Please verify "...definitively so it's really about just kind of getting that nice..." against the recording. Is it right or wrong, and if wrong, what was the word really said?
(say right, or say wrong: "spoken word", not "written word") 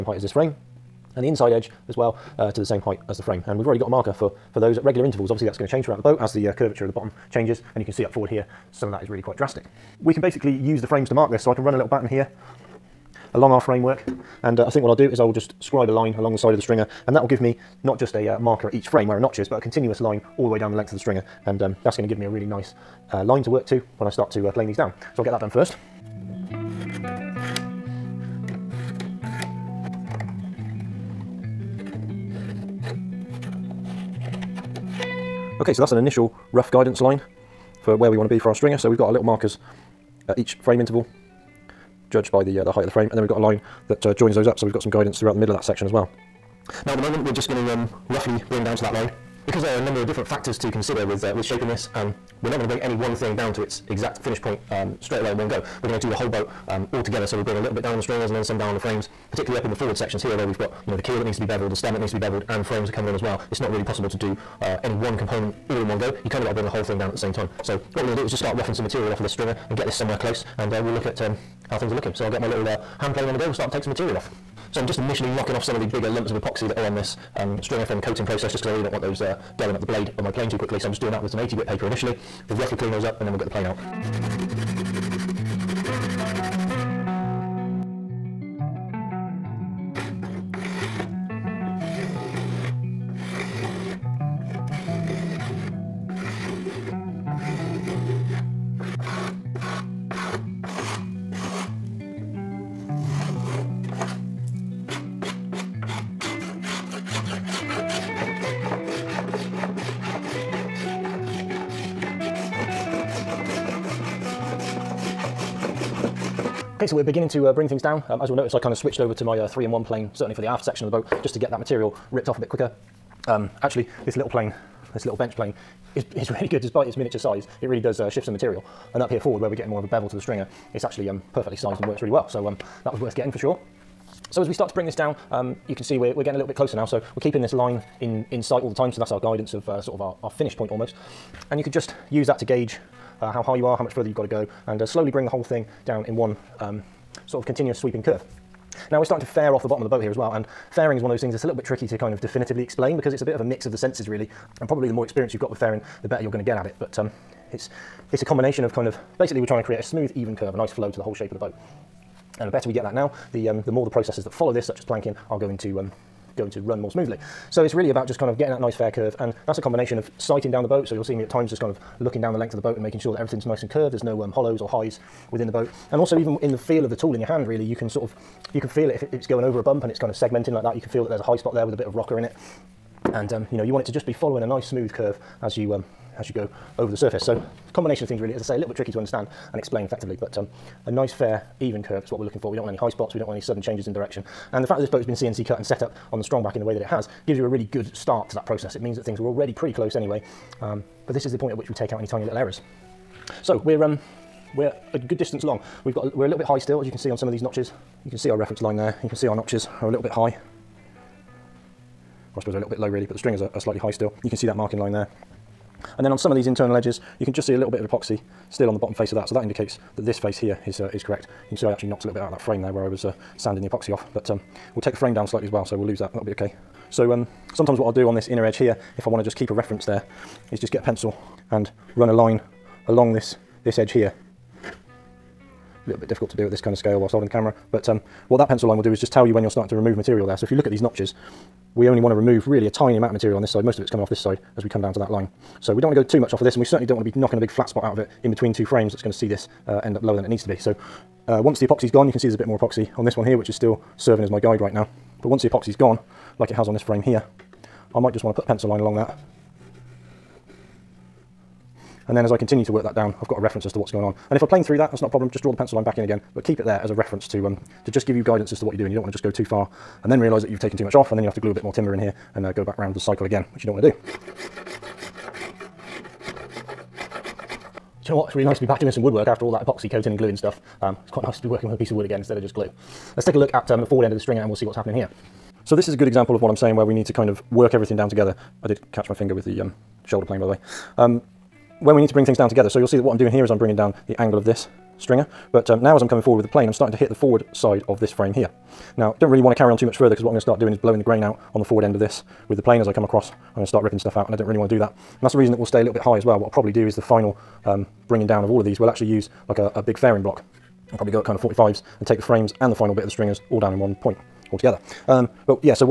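wrong: "smoothly", not "definitively".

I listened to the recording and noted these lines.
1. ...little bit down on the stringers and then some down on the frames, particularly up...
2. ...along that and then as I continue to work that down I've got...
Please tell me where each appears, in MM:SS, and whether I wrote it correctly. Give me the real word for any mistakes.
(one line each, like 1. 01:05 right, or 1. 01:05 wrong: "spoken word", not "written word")
1. 00:57 right
2. 04:18 right.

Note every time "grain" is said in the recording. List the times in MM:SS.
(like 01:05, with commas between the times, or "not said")
05:01.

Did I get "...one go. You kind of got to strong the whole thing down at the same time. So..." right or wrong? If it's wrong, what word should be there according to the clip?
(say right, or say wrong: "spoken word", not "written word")
wrong: "bring", not "strong".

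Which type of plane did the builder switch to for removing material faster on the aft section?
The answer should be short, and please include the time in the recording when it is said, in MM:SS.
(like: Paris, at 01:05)
three-in-one plane, at 01:59.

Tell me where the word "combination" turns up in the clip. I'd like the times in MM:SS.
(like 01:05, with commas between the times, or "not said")
02:38, 02:49, 03:07.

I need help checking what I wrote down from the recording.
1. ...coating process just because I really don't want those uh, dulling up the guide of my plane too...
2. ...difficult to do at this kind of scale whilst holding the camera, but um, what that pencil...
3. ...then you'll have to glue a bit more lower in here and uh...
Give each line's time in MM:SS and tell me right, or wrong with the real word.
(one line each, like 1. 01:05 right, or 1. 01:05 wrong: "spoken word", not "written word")
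1. 01:18 wrong: "blade", not "guide"
2. 03:56 right
3. 04:31 wrong: "timber", not "lower".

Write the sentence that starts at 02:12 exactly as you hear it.
So um, that was worth getting for sure.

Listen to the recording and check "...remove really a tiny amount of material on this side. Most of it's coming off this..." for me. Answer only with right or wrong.
right.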